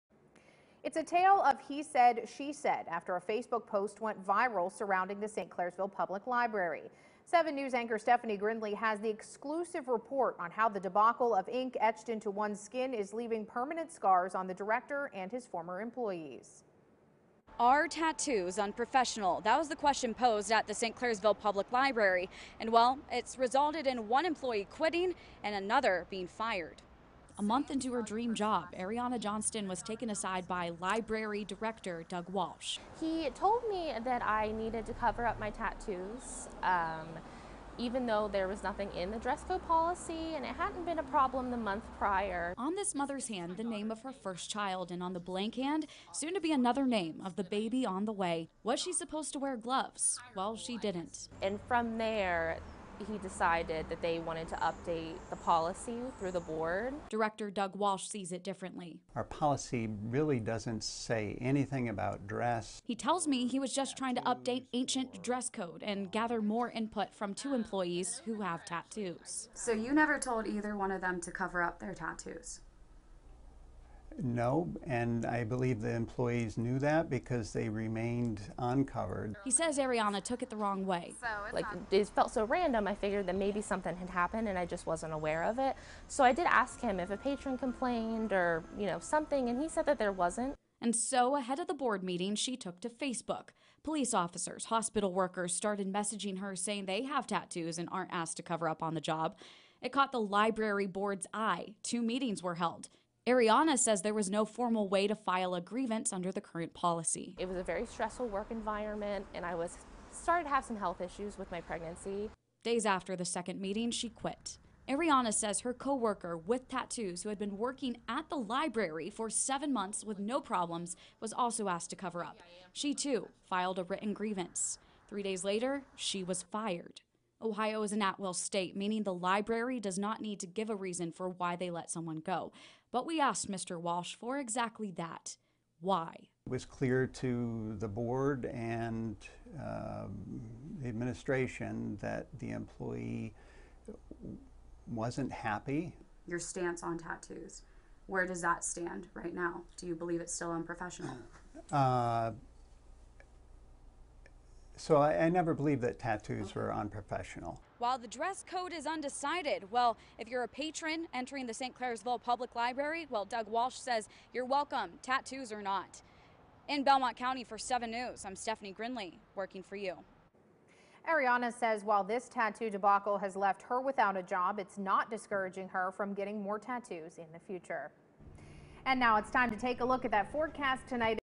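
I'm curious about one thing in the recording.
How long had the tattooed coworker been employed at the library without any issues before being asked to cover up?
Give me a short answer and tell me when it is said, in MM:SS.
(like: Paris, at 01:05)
7 months, at 01:59.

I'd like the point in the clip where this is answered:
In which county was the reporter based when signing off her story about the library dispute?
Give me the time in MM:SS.
02:46.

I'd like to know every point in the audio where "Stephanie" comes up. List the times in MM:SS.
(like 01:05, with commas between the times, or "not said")
00:07, 02:48.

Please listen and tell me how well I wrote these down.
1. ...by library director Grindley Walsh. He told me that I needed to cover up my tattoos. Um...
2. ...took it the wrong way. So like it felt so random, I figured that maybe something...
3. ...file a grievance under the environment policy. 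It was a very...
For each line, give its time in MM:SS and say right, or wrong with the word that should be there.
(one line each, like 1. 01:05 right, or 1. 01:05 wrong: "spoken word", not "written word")
1. 00:30 wrong: "Doug", not "Grindley"
2. 01:20 right
3. 01:45 wrong: "current", not "environment".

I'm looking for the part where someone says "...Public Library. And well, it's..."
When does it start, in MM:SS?
00:21.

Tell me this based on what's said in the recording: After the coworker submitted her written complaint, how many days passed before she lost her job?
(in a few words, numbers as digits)
3.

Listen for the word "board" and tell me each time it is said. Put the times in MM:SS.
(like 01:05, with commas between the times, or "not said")
00:56, 01:31, 01:40, 02:17.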